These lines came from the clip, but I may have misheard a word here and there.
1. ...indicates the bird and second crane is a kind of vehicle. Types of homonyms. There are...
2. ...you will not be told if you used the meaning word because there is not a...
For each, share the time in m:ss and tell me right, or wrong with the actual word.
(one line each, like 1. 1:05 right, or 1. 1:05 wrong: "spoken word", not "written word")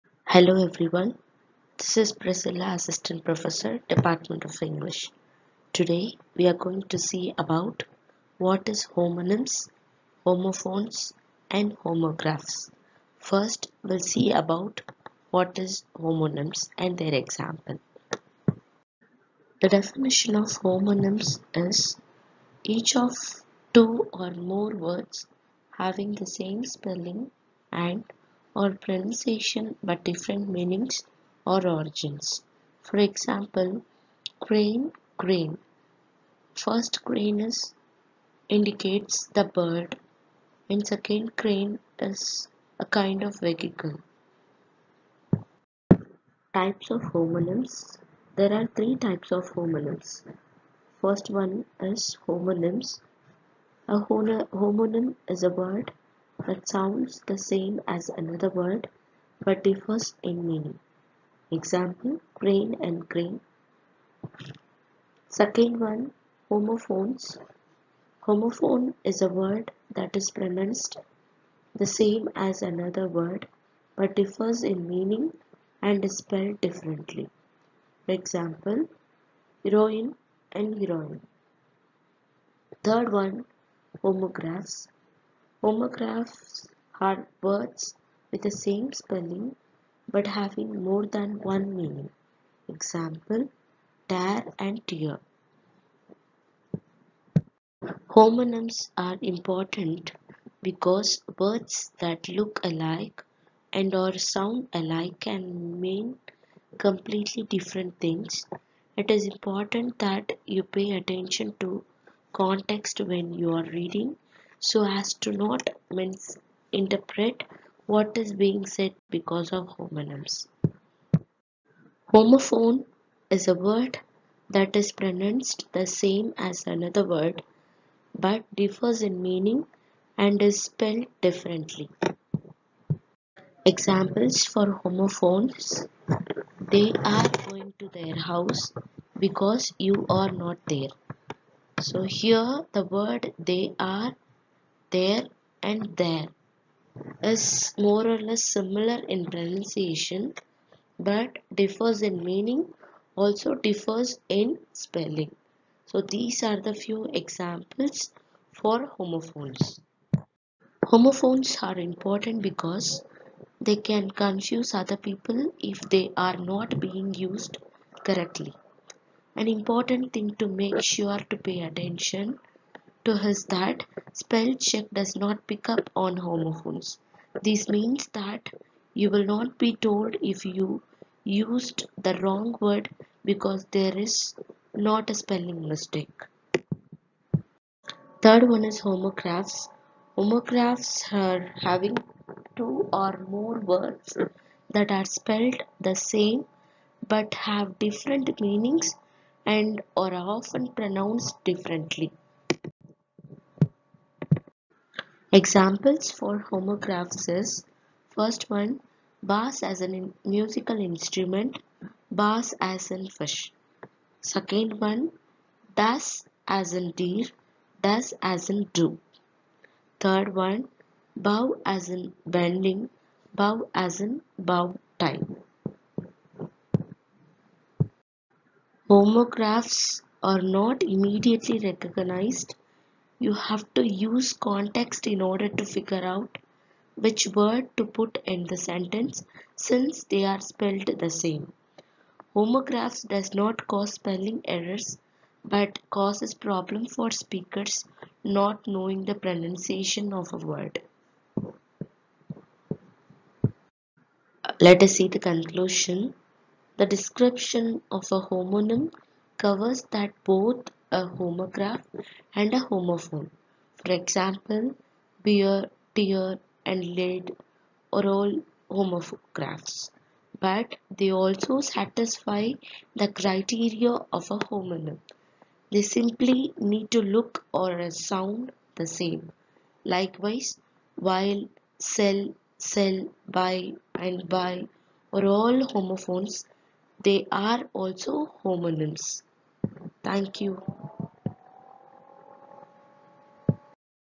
1. 0:38 right
2. 2:58 wrong: "wrong", not "meaning".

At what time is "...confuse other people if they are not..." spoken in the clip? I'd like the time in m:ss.
2:44.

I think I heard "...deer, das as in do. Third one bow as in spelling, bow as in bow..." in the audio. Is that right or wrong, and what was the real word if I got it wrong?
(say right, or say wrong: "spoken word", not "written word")
wrong: "bending", not "spelling".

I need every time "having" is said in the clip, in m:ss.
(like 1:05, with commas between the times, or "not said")
0:25, 1:30, 3:11.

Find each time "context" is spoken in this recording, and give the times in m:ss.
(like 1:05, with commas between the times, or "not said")
1:52, 3:54.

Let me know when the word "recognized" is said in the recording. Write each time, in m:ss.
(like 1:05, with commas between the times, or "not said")
3:51.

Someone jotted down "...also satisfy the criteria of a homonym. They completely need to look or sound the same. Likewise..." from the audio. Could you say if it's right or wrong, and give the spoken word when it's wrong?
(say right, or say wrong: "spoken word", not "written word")
wrong: "simply", not "completely".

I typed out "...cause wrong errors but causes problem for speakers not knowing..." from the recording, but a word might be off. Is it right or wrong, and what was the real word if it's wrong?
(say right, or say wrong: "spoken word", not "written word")
wrong: "spelling", not "wrong".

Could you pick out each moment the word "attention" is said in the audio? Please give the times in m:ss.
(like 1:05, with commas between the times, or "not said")
1:50, 2:51.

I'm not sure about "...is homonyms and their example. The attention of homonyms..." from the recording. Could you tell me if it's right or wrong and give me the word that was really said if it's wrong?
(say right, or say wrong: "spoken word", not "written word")
wrong: "definition", not "attention".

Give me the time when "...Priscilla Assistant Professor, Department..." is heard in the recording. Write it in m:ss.
0:02.